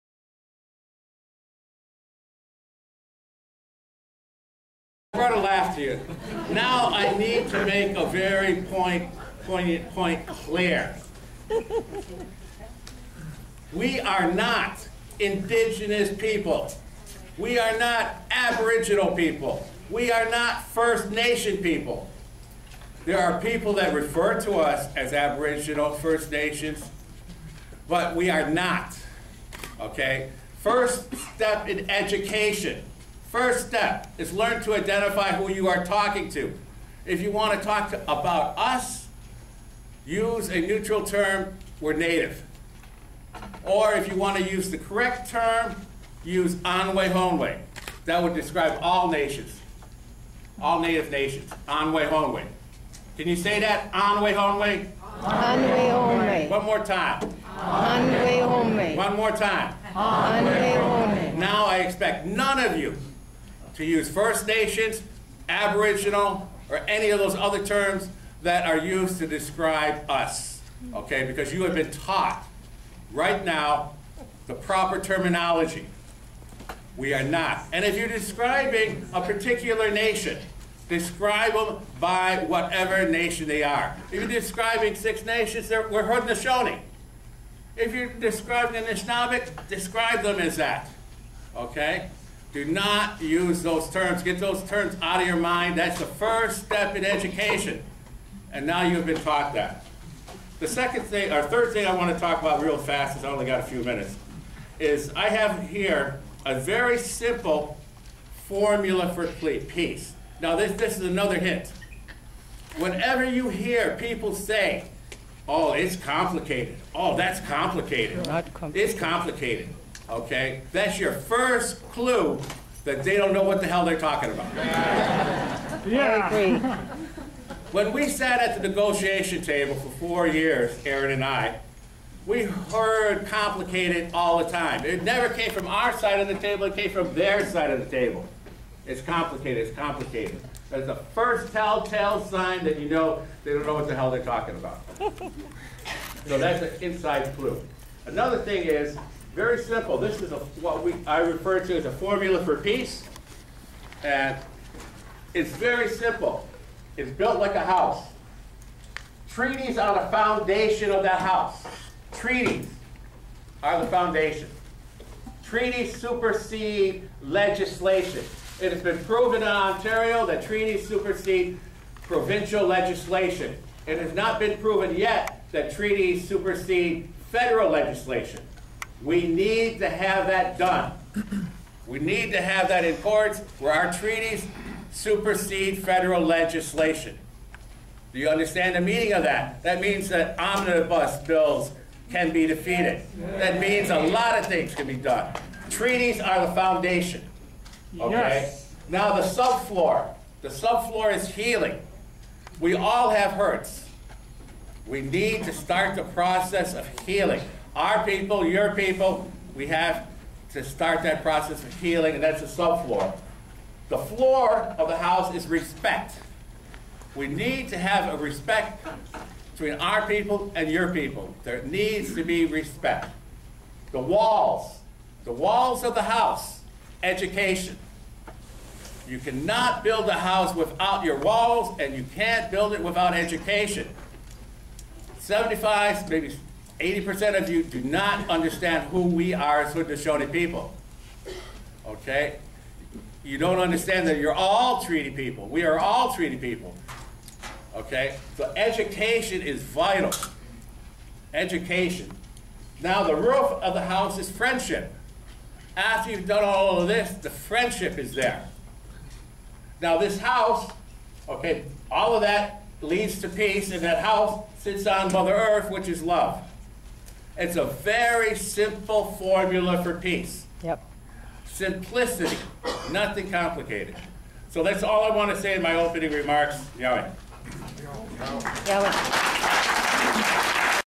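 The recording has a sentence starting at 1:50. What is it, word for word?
Now this, this is another hint.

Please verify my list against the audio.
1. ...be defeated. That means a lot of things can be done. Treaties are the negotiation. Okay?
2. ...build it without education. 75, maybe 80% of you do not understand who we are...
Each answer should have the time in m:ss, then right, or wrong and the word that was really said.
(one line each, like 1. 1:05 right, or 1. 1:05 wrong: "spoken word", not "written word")
1. 3:12 wrong: "foundation", not "negotiation"
2. 3:52 right.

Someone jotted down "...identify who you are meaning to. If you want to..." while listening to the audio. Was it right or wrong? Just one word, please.
wrong.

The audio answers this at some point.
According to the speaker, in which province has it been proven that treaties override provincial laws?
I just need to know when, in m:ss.
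2:49.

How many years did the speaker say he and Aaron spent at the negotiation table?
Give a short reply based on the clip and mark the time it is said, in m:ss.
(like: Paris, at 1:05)
4, at 2:09.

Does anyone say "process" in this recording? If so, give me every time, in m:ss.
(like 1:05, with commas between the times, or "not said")
3:26, 3:31.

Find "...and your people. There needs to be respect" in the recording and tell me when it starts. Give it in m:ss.
3:40.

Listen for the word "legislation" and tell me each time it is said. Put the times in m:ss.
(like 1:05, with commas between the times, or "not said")
2:47, 2:52, 2:57, 3:06.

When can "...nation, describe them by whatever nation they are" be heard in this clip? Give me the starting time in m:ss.
1:19.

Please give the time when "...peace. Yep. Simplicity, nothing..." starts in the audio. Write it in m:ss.
4:29.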